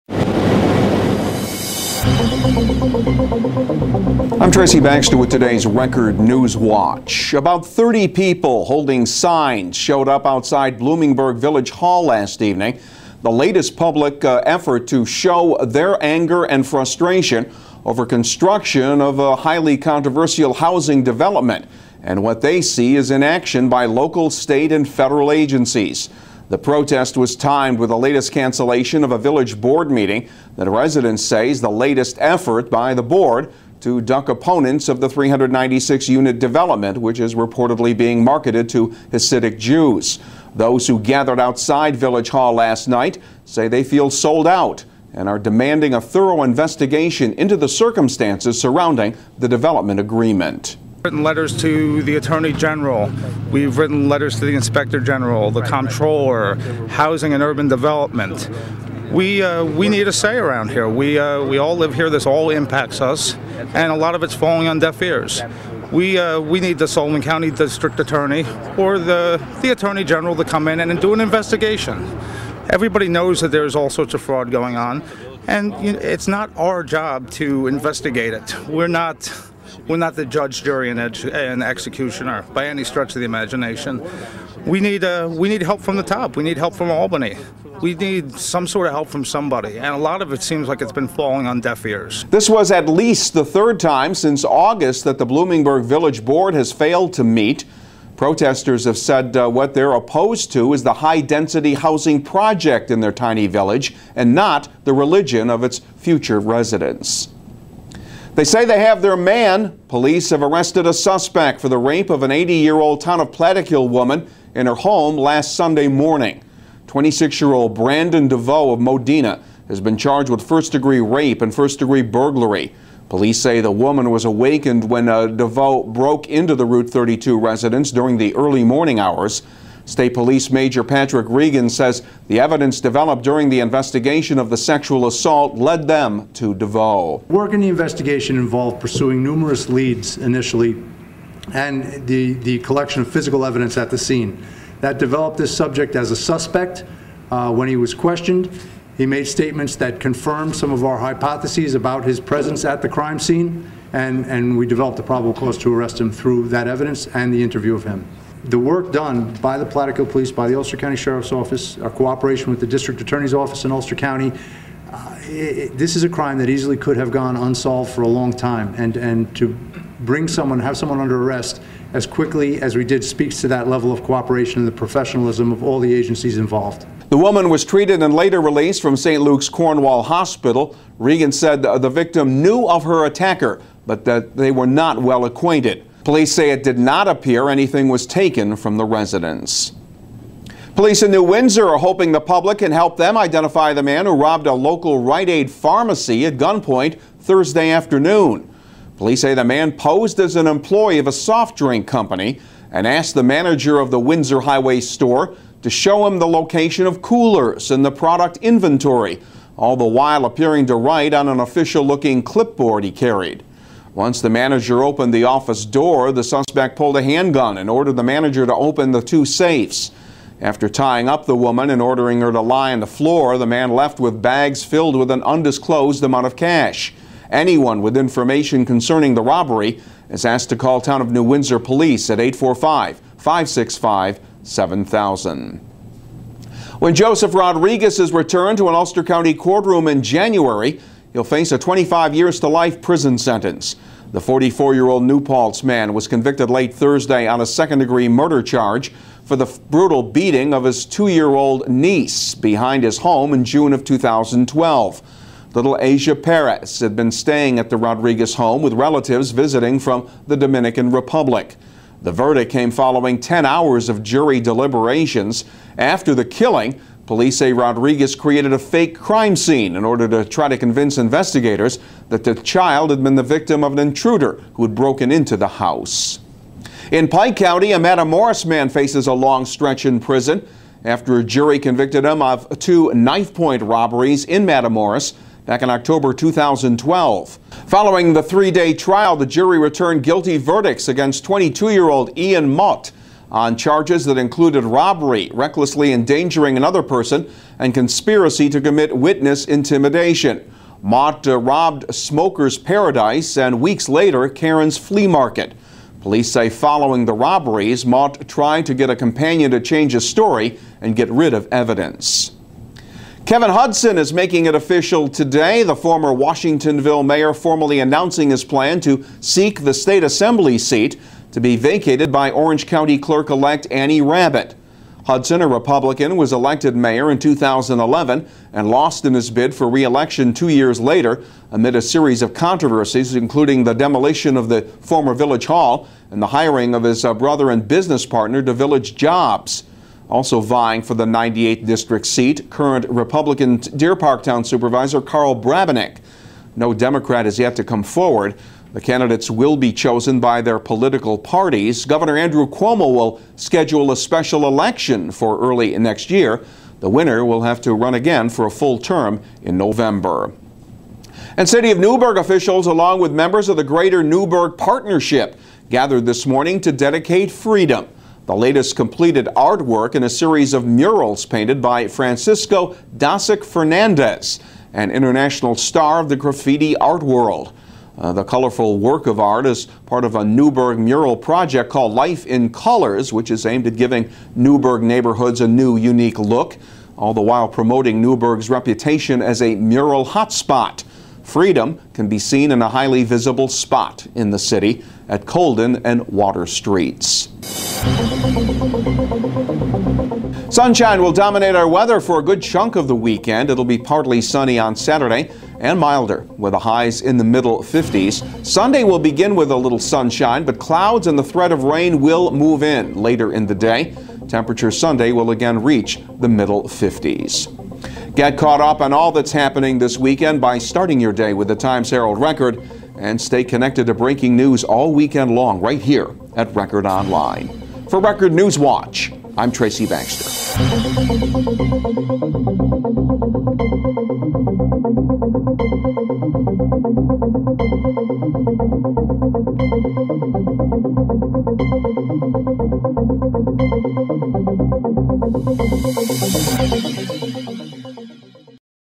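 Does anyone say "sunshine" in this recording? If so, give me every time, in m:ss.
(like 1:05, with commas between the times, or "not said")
6:40, 6:49.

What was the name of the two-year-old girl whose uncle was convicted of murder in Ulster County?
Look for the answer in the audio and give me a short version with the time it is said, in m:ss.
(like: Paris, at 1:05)
Asia Perez, at 4:15.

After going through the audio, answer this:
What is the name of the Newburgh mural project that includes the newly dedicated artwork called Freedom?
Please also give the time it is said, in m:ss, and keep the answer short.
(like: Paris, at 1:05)
Life in Colors, at 6:21.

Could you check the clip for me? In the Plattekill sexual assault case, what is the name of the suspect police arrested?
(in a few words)
Brandon DeVoe.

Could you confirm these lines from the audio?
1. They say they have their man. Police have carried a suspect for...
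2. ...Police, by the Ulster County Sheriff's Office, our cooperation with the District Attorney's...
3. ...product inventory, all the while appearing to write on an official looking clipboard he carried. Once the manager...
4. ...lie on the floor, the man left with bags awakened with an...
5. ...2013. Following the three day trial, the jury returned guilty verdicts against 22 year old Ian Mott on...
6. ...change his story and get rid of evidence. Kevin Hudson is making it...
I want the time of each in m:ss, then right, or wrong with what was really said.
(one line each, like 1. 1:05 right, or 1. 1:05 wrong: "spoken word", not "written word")
1. 1:48 wrong: "arrested", not "carried"
2. 2:40 right
3. 3:27 right
4. 3:42 wrong: "filled", not "awakened"
5. 4:46 wrong: "2012", not "2013"
6. 5:09 right.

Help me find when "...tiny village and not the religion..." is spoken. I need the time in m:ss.
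1:43.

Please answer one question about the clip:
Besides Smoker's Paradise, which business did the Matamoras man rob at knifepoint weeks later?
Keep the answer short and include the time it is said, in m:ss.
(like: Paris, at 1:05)
Karen's Flea Market, at 5:04.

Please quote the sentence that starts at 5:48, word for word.
The candidates will be chosen by their political parties.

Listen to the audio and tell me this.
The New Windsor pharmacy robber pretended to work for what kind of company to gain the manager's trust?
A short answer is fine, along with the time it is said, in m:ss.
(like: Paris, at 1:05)
Soft drink company, at 3:21.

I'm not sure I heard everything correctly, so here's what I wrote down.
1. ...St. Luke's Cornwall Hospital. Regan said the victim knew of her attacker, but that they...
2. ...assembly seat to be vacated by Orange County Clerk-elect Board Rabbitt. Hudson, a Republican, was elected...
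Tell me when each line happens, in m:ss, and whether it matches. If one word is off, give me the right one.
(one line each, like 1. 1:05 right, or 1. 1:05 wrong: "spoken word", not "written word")
1. 2:58 right
2. 5:20 wrong: "Annie", not "Board".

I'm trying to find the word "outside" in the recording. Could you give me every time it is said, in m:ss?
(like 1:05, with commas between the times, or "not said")
0:10, 0:41.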